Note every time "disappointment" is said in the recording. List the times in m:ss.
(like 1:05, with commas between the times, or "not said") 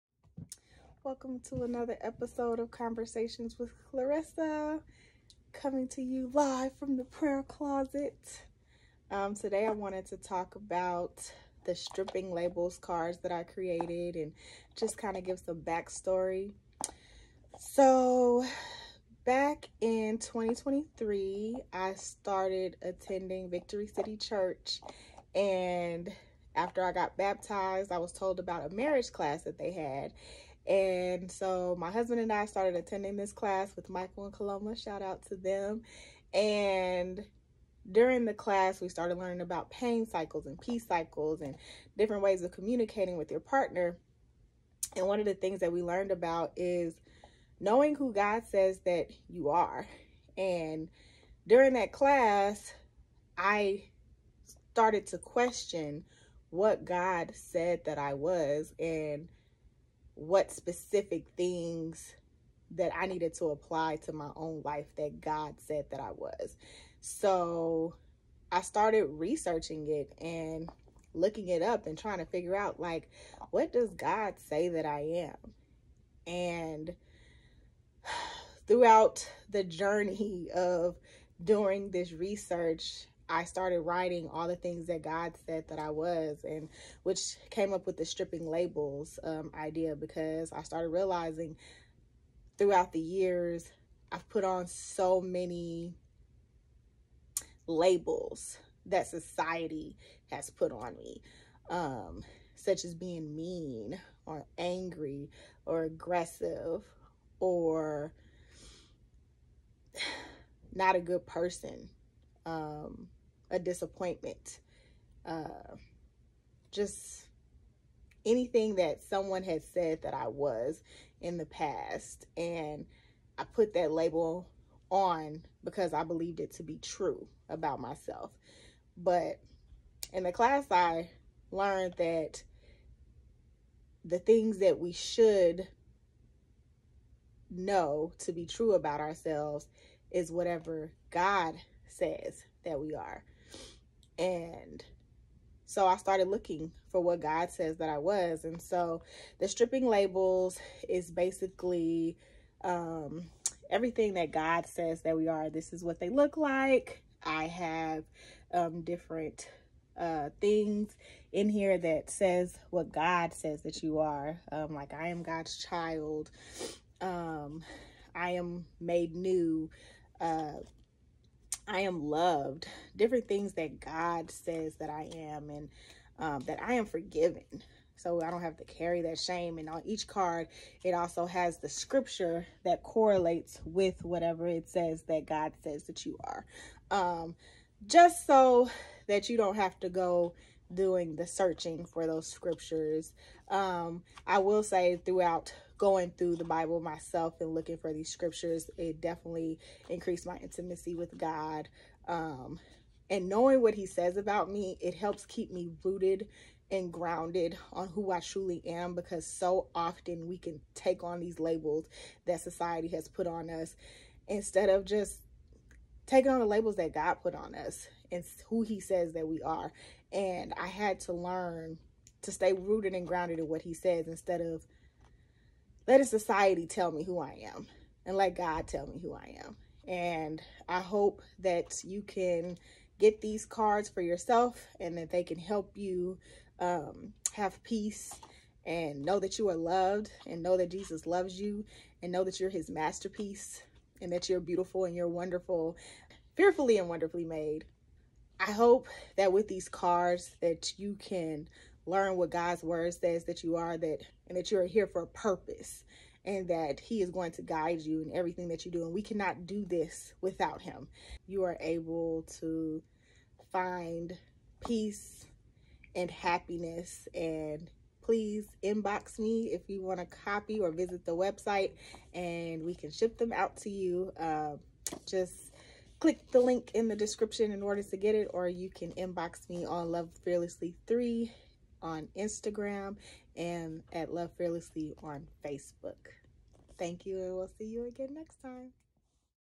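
1:53.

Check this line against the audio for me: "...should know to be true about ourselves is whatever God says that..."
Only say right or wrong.
right.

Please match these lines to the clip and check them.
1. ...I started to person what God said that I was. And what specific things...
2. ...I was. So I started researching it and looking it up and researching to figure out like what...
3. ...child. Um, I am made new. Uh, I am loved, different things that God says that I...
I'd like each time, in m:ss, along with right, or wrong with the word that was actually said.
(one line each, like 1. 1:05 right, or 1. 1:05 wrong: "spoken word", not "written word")
1. 0:53 wrong: "question", not "person"
2. 1:05 wrong: "trying", not "researching"
3. 2:45 right.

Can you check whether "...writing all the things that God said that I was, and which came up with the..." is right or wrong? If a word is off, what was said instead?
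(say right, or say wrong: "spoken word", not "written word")
right.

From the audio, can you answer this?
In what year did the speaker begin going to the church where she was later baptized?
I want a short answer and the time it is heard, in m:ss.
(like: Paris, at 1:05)
2023, at 0:20.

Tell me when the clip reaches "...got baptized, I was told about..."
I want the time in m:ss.
0:26.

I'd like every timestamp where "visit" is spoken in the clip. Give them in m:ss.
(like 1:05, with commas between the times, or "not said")
4:30.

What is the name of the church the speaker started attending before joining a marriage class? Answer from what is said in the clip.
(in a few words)
Victory City Church.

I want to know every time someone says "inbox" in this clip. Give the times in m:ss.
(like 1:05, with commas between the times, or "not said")
4:28, 4:38.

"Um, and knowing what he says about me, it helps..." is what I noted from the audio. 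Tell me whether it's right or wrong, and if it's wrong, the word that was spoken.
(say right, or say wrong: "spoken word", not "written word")
right.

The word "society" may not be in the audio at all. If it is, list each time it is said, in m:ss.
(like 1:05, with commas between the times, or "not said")
1:39, 3:32, 3:46.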